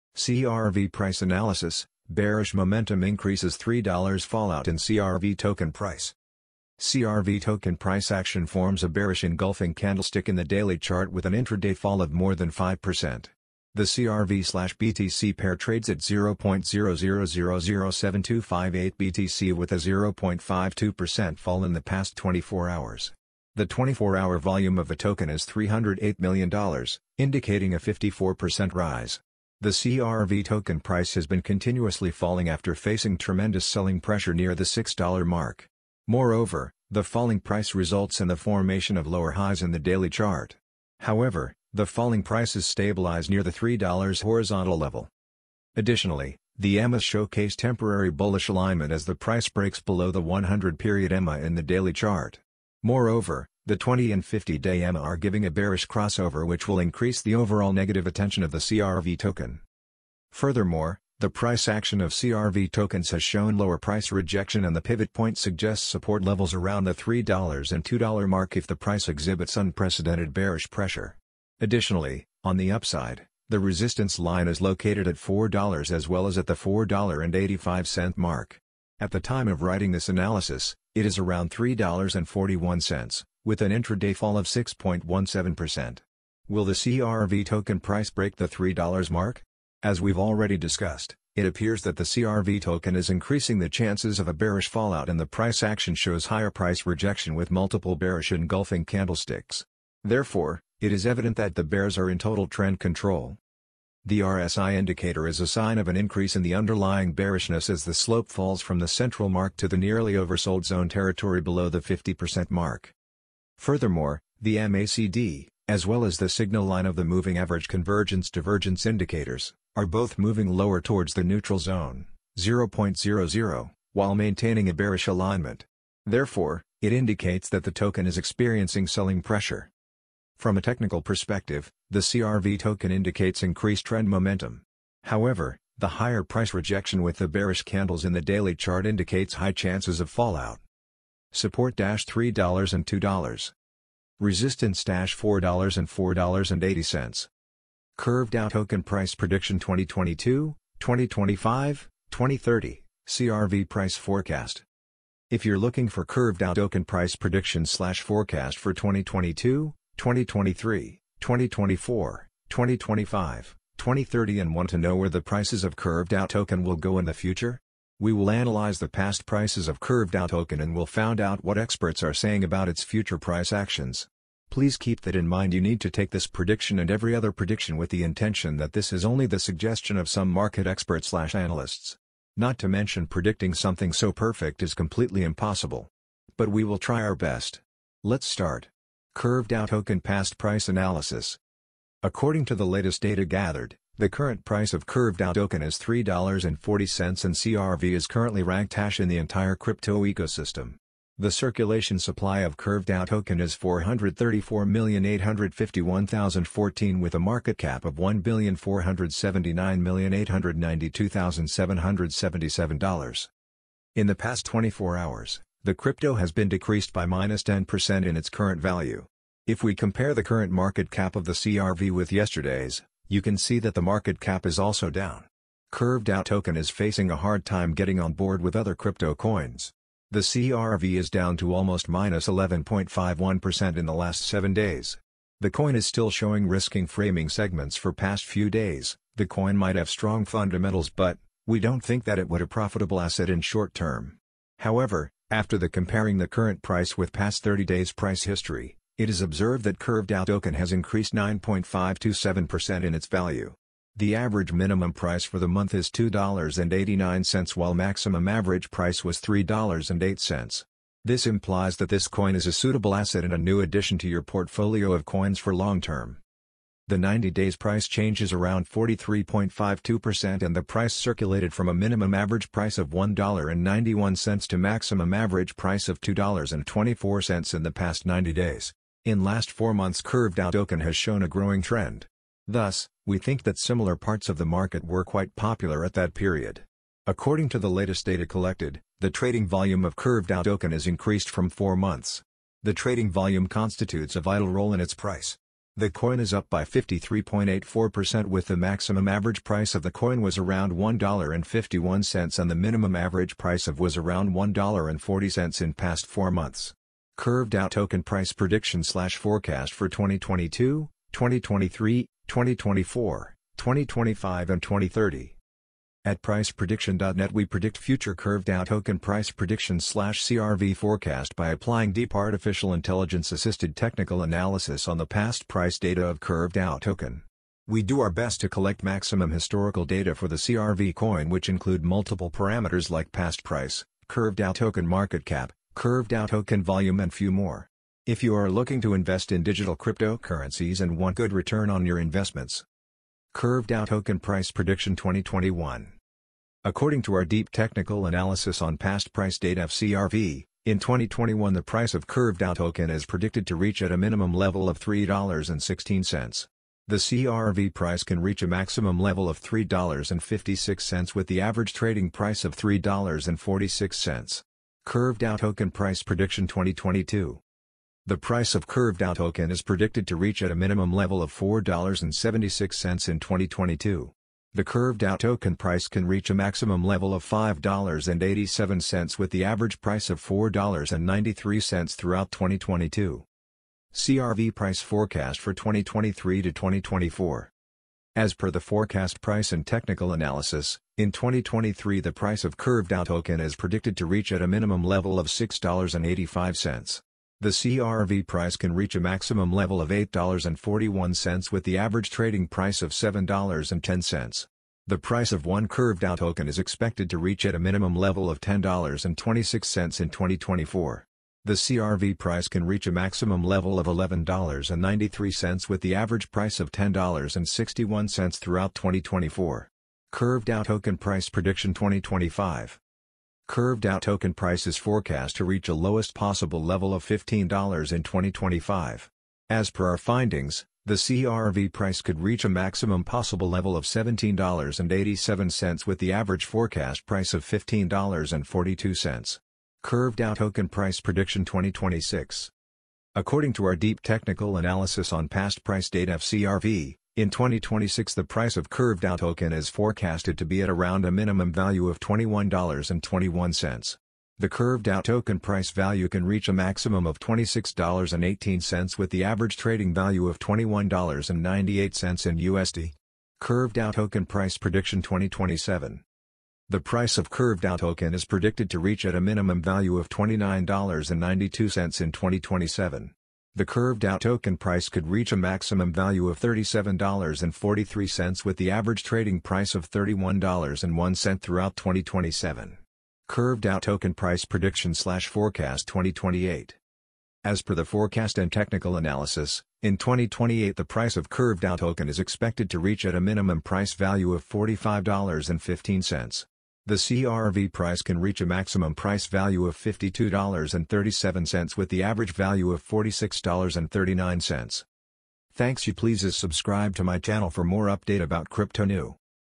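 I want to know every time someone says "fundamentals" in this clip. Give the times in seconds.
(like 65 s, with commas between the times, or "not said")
240 s.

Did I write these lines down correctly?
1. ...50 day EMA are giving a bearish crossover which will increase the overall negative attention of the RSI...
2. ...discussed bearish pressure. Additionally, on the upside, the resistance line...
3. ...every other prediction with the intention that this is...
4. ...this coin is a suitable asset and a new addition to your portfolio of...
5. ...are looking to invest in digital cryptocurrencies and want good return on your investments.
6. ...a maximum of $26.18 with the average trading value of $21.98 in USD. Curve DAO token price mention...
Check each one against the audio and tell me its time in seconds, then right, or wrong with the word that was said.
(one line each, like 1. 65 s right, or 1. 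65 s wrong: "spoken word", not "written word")
1. 54 s wrong: "CRV", not "RSI"
2. 69 s wrong: "unprecedented", not "discussed"
3. 176 s right
4. 261 s right
5. 338 s right
6. 456 s wrong: "prediction", not "mention".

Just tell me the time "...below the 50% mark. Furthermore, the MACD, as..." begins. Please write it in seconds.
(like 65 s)
111 s.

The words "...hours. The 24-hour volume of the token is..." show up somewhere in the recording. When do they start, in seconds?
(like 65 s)
22 s.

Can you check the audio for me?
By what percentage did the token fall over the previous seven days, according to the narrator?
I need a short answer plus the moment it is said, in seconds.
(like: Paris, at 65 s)
11.51%, at 232 s.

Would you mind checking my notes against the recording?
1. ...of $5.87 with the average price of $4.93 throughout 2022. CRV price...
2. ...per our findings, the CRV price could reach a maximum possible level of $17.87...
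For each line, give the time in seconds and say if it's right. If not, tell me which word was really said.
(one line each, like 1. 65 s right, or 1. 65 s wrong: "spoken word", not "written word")
1. 377 s right
2. 429 s right.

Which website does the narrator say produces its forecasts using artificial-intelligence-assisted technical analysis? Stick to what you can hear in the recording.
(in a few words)
priceprediction.net.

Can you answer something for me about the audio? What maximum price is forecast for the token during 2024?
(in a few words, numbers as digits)
$11.93.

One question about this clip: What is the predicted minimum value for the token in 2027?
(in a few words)
$29.92.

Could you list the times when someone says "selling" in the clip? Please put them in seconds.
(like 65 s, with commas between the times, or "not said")
33 s, 128 s.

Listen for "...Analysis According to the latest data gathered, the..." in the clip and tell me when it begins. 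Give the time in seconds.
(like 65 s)
190 s.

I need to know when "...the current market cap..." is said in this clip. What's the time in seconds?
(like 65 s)
220 s.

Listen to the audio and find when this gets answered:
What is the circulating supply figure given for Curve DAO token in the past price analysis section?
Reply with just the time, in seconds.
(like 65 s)
203 s.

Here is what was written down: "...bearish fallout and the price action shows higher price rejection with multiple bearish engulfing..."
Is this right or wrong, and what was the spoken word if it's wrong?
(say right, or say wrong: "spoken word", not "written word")
right.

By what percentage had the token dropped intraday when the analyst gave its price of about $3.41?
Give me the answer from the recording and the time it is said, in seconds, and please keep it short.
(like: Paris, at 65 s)
6.17%, at 84 s.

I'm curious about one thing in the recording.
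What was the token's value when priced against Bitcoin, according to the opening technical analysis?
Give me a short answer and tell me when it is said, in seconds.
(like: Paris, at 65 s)
0.00007258 BTC, at 15 s.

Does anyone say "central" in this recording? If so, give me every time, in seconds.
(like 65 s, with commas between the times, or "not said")
108 s.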